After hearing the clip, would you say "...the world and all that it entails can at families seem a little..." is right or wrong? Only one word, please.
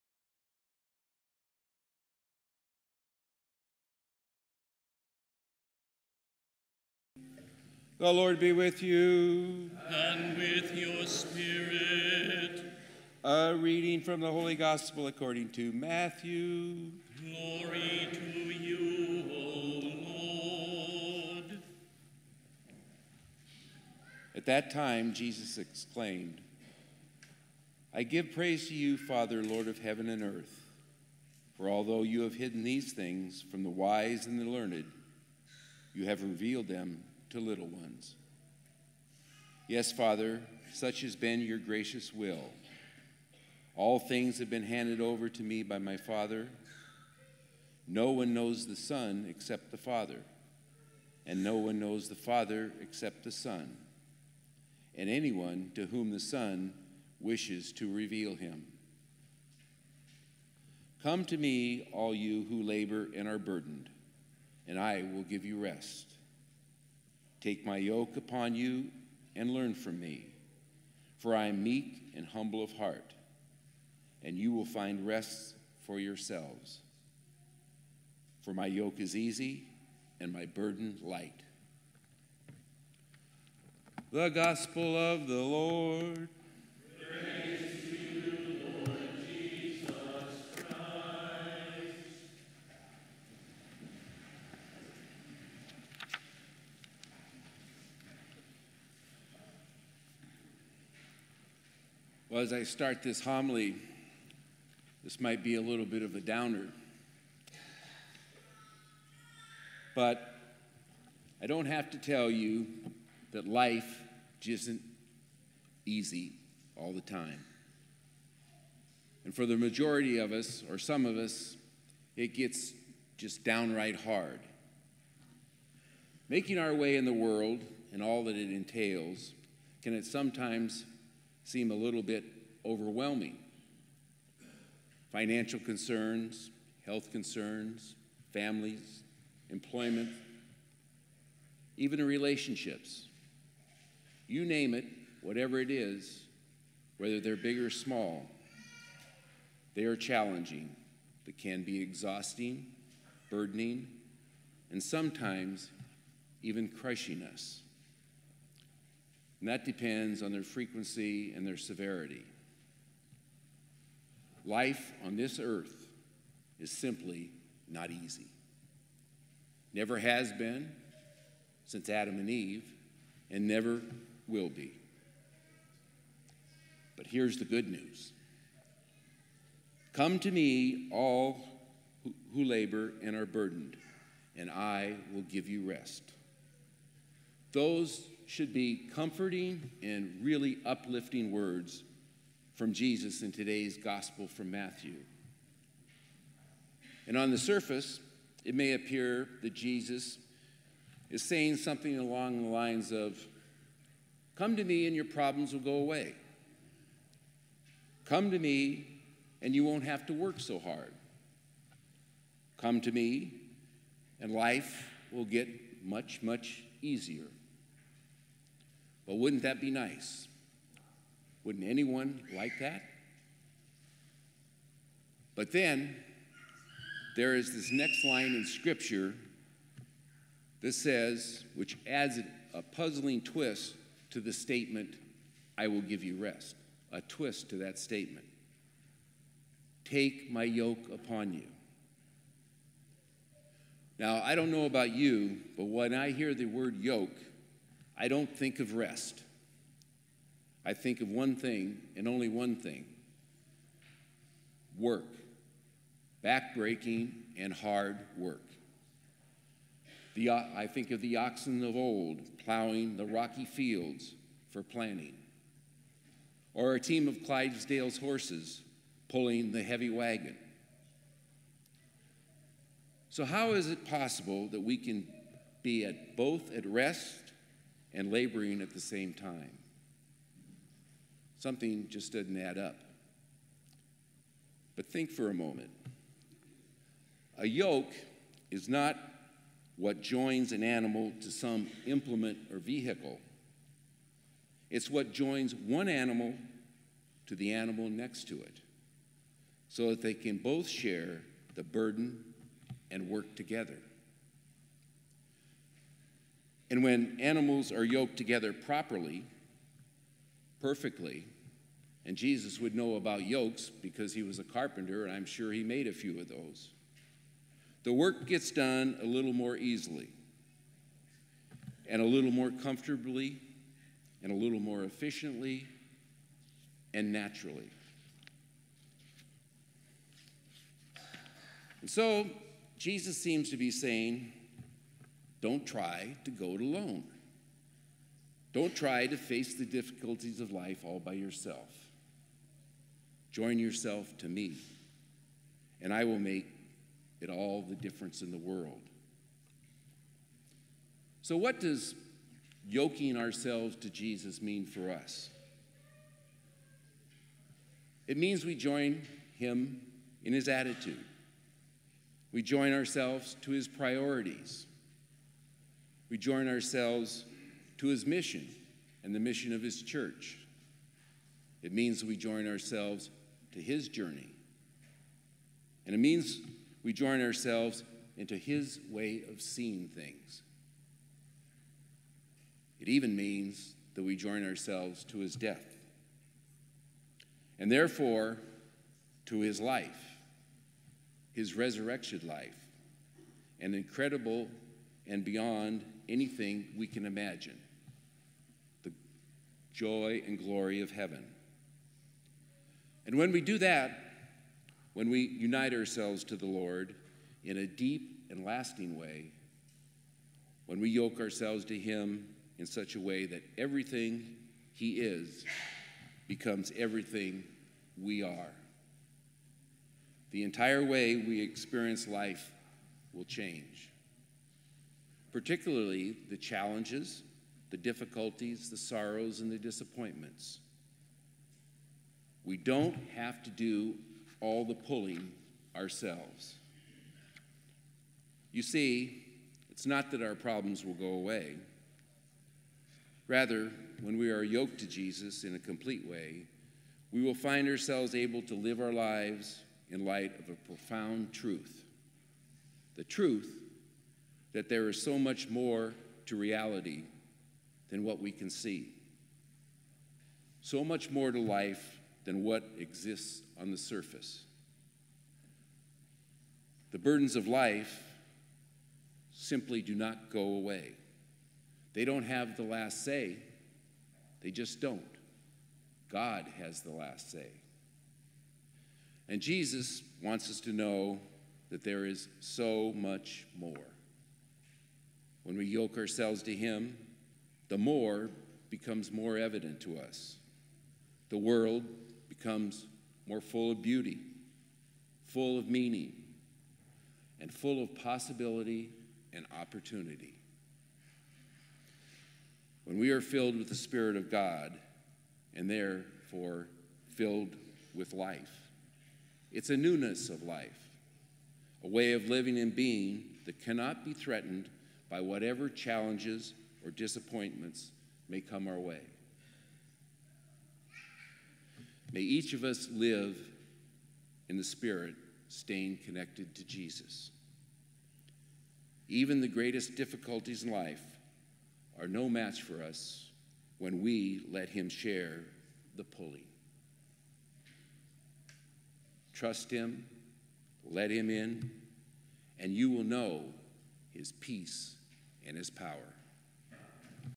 wrong.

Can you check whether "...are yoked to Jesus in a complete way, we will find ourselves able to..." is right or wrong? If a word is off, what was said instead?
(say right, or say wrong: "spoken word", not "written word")
right.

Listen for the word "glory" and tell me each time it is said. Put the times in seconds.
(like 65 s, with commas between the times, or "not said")
17 s, 400 s.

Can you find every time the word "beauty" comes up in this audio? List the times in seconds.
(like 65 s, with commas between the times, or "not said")
493 s.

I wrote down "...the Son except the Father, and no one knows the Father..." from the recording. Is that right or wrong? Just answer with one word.
right.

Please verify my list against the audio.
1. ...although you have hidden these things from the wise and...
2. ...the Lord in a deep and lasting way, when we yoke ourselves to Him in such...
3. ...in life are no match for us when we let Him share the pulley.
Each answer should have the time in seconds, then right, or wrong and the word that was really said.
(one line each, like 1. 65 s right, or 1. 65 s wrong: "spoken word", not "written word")
1. 31 s right
2. 406 s right
3. 530 s right.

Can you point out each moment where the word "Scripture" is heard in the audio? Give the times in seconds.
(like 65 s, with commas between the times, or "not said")
228 s.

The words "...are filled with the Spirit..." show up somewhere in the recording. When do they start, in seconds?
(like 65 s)
503 s.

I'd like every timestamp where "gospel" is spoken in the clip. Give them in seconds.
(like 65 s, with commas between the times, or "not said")
14 s, 84 s, 193 s.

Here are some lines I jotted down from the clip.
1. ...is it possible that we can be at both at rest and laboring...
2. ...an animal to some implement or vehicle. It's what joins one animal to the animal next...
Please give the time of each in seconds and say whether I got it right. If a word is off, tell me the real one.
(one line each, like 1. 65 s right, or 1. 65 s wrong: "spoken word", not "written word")
1. 273 s right
2. 290 s right.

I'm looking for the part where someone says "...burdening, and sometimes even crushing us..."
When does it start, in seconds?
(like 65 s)
153 s.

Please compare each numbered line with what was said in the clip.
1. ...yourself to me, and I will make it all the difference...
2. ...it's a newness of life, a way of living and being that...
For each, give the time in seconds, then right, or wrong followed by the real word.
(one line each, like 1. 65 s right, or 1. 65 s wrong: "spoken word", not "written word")
1. 343 s right
2. 509 s right.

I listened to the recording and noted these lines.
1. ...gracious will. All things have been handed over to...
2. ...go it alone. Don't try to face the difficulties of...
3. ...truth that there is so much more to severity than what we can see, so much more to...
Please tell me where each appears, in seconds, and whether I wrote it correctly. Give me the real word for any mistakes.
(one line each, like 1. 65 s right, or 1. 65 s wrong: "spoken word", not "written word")
1. 41 s right
2. 336 s right
3. 453 s wrong: "reality", not "severity".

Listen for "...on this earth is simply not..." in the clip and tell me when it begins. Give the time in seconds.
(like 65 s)
165 s.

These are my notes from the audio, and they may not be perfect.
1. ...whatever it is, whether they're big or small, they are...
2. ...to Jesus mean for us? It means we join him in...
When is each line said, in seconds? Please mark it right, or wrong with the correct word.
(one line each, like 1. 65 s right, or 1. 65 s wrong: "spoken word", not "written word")
1. 145 s right
2. 353 s right.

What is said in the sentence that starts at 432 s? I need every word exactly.
We don't have to do all the pulling ourselves.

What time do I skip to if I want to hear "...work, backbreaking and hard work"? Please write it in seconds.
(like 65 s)
254 s.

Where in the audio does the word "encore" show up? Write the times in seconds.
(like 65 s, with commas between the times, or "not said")
not said.